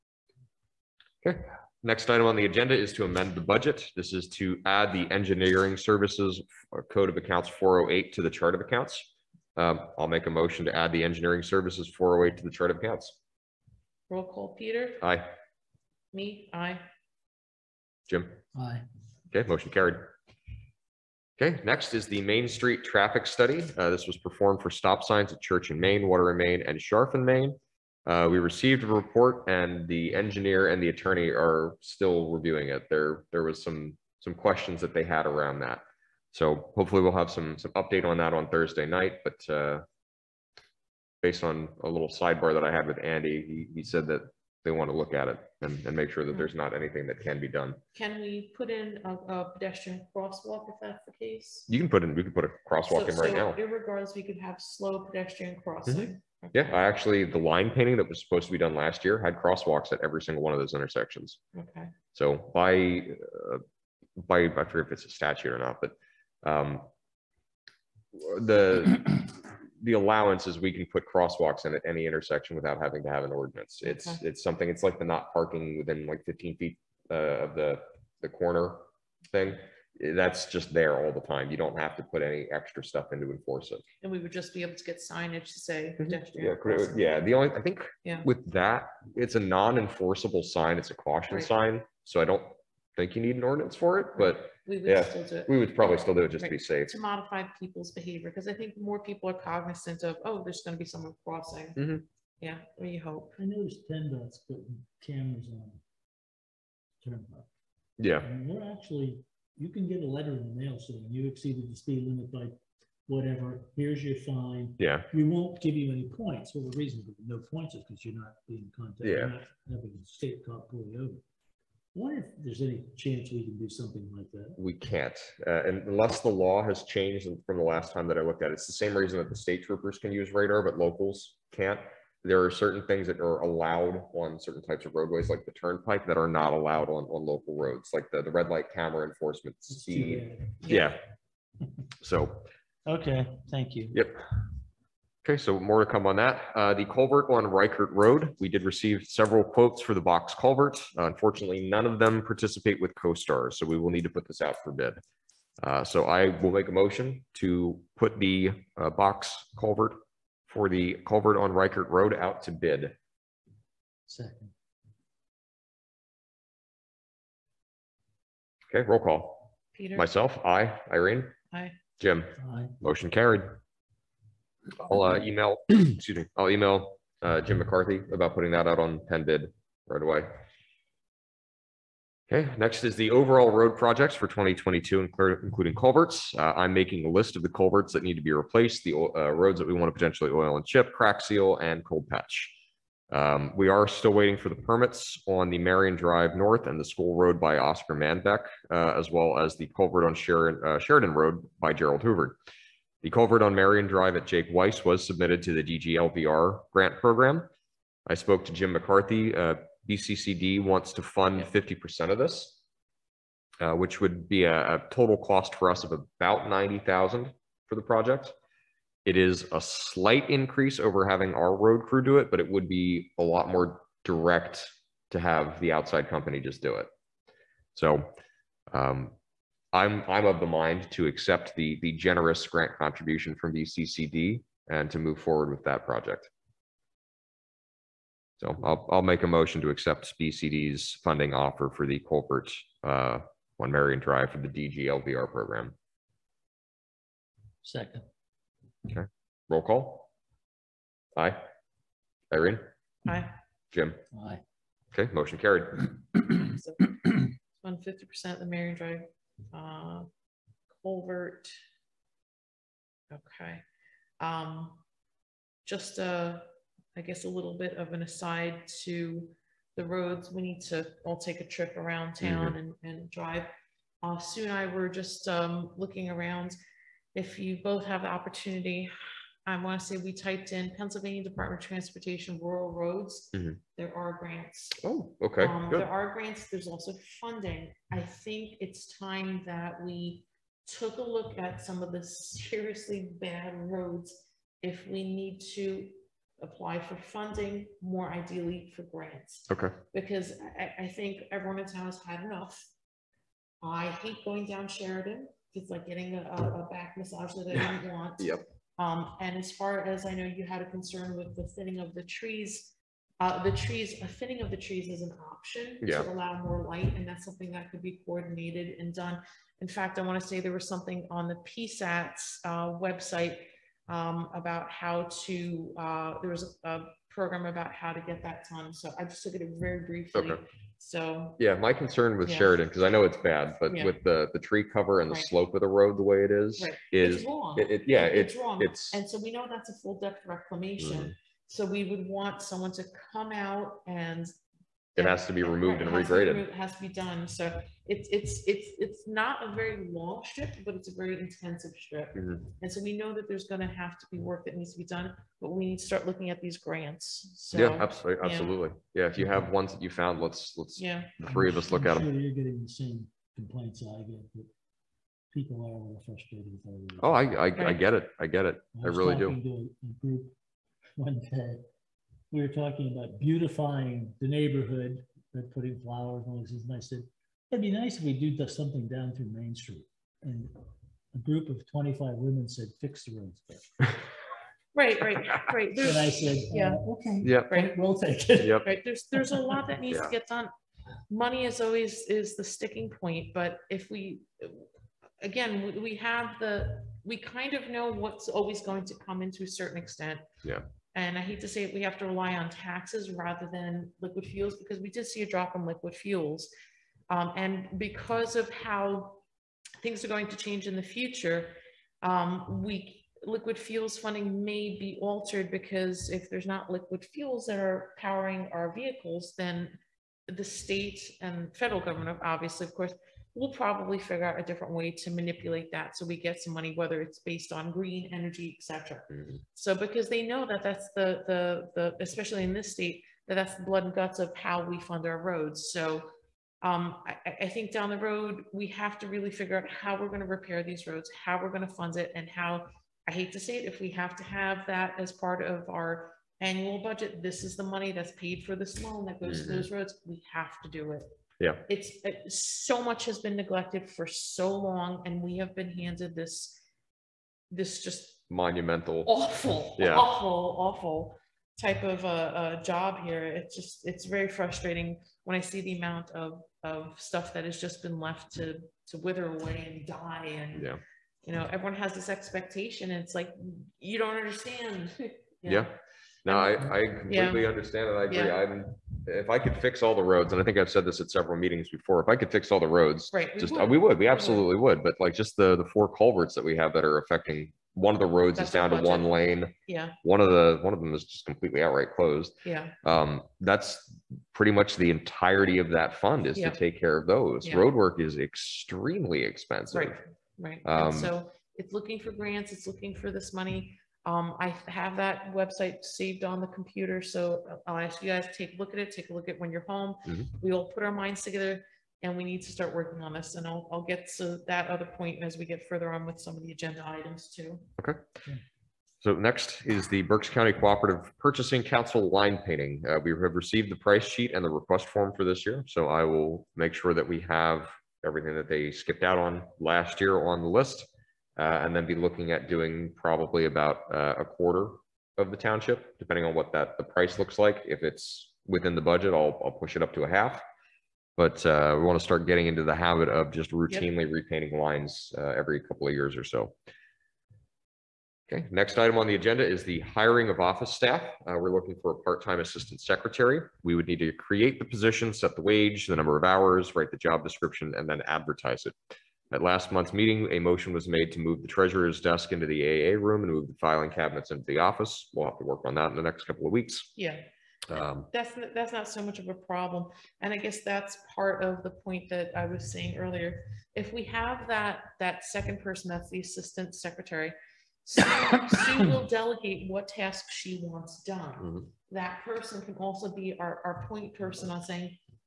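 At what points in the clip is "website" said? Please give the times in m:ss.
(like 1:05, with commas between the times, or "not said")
5:22, 8:25.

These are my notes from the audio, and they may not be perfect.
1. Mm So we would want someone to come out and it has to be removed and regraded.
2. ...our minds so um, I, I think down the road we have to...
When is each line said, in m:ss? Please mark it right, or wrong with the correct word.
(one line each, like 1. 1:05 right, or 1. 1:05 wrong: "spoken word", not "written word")
1. 5:41 right
2. 7:15 wrong: "roads", not "minds".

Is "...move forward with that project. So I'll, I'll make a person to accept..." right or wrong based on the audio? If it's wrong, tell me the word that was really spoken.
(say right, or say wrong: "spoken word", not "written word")
wrong: "motion", not "person".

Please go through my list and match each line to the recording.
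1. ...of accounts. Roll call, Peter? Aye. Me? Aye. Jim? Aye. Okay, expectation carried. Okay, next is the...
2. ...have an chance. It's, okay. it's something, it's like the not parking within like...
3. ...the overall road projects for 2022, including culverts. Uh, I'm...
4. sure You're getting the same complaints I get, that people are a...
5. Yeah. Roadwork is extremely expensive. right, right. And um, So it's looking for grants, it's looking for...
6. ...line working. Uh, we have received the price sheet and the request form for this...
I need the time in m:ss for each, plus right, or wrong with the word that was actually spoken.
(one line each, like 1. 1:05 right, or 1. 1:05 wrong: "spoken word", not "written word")
1. 0:12 wrong: "motion", not "expectation"
2. 1:13 wrong: "ordinance", not "chance"
3. 3:02 right
4. 6:02 right
5. 8:17 right
6. 8:42 wrong: "painting", not "working".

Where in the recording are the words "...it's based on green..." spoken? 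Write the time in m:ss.
7:07.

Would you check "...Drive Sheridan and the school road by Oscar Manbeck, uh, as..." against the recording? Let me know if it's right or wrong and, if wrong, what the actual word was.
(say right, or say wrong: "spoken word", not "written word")
wrong: "North", not "Sheridan".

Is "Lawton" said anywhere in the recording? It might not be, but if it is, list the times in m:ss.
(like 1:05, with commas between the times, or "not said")
not said.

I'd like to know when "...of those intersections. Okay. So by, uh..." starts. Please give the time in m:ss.
1:00.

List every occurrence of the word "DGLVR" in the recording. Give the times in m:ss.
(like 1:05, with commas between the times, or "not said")
3:25, 4:04.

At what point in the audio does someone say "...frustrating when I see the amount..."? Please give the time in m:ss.
7:44.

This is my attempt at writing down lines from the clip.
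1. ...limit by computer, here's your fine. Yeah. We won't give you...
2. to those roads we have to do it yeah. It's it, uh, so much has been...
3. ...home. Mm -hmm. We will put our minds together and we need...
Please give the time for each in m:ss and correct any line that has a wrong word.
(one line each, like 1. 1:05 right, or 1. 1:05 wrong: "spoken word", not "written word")
1. 1:52 wrong: "whatever", not "computer"
2. 7:29 right
3. 8:29 right.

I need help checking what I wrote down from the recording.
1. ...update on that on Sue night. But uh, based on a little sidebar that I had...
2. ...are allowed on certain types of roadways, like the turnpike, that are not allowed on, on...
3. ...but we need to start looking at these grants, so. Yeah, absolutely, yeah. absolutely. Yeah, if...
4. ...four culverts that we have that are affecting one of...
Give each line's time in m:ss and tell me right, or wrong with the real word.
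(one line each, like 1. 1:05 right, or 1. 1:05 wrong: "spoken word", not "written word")
1. 0:37 wrong: "Thursday", not "Sue"
2. 2:13 right
3. 5:55 right
4. 8:05 right.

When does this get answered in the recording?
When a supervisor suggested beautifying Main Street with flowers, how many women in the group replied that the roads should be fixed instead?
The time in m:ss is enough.
6:21.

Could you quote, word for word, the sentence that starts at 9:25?
We'll have to work on that in the next couple of weeks.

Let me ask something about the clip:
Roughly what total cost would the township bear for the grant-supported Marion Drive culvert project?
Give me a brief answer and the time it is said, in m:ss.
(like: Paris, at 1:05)
90,000, at 3:36.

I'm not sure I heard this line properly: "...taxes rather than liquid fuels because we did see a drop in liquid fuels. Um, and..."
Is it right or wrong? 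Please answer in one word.
right.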